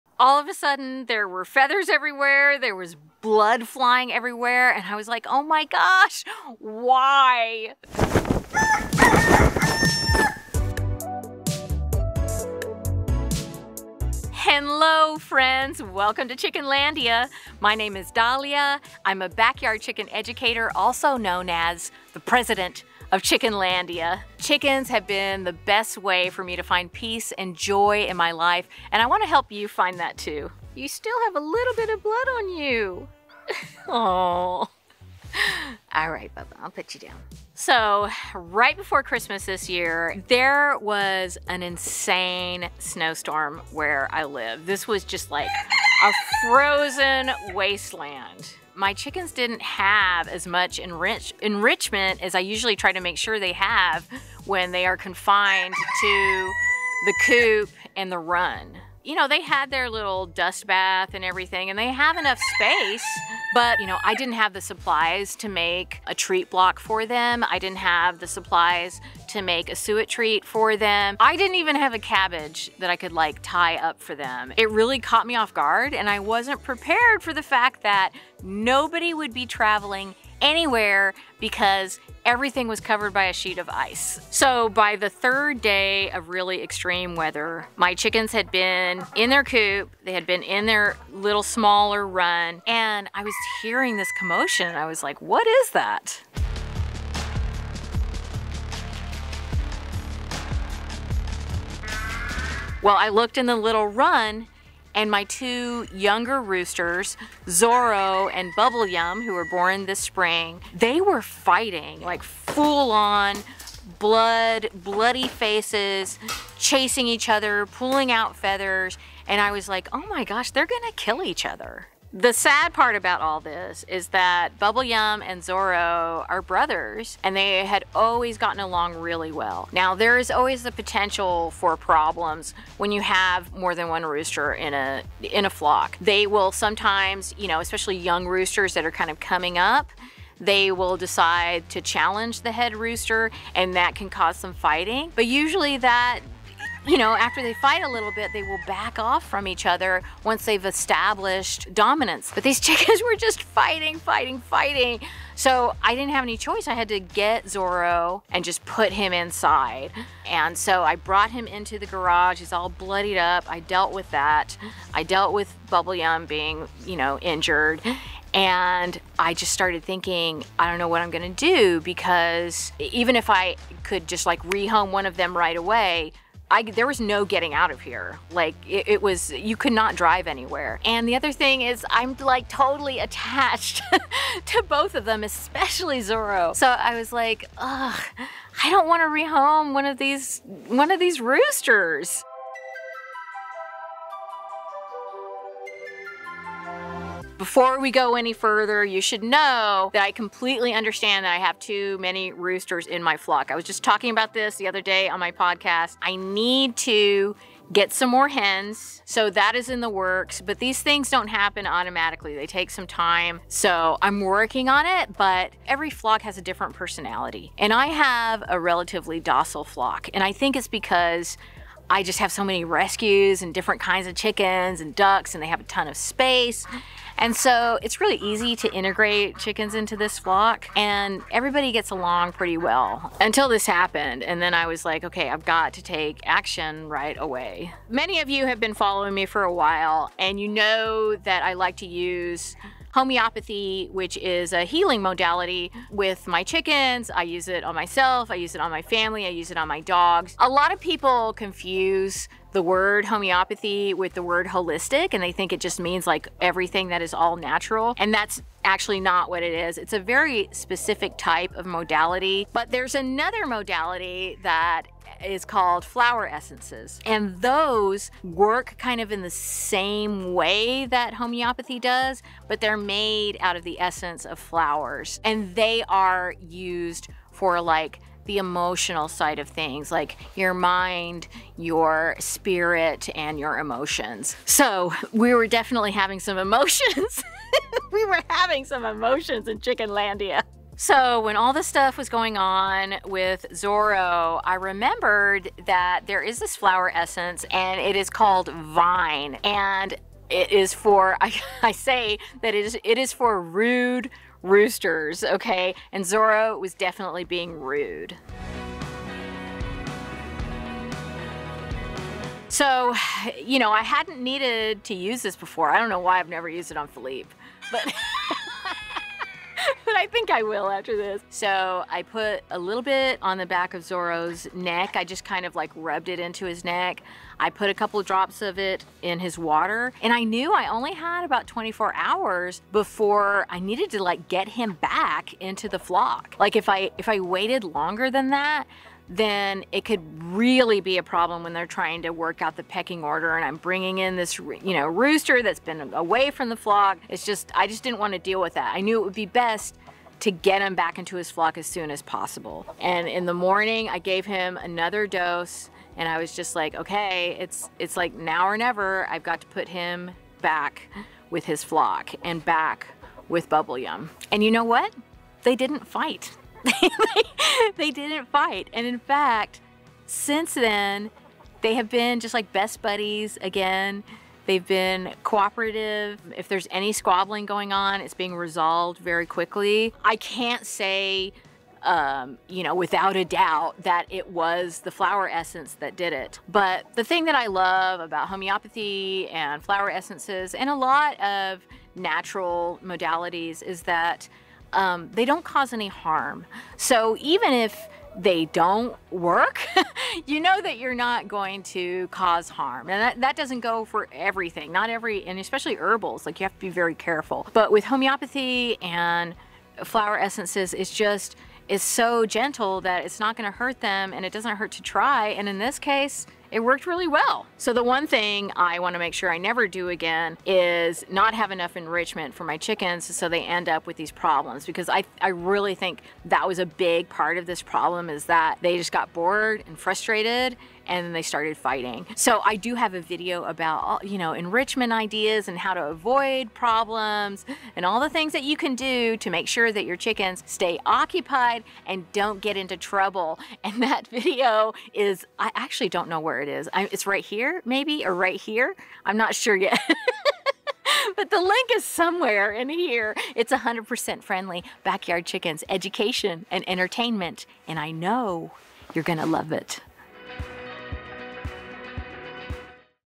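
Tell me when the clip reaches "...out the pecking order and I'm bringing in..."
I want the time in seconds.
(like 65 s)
342 s.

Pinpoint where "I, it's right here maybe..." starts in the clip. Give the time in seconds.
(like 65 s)
446 s.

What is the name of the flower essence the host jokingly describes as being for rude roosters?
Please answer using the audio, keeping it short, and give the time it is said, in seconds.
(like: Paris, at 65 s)
Vine, at 298 s.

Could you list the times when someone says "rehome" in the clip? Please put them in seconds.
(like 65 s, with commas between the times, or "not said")
174 s, 189 s.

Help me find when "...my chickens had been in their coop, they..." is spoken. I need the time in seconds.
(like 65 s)
87 s.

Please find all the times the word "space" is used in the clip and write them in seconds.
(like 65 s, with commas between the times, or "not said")
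62 s, 225 s.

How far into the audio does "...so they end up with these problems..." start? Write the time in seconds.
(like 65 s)
423 s.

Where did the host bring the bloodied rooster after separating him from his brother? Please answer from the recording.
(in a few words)
the garage.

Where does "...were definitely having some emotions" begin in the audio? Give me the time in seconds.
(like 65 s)
285 s.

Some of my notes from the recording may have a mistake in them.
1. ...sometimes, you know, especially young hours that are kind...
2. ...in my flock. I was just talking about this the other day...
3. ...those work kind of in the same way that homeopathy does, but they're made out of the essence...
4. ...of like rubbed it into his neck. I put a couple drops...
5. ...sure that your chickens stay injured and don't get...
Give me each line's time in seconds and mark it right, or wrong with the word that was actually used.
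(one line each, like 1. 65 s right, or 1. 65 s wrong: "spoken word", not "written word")
1. 136 s wrong: "roosters", not "hours"
2. 202 s right
3. 267 s right
4. 325 s right
5. 439 s wrong: "occupied", not "injured".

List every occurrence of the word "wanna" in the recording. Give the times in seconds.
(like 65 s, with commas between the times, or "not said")
29 s, 418 s.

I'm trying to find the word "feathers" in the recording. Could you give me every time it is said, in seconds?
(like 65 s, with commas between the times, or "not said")
1 s, 118 s.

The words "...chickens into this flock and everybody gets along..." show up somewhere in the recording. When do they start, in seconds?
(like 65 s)
229 s.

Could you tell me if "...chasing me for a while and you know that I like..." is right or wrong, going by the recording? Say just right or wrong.
wrong.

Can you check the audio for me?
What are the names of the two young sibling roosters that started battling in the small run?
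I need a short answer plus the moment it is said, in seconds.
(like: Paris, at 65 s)
Zorro and Bubble Yum, at 107 s.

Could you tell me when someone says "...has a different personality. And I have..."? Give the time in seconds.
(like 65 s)
216 s.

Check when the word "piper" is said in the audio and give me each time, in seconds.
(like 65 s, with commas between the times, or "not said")
not said.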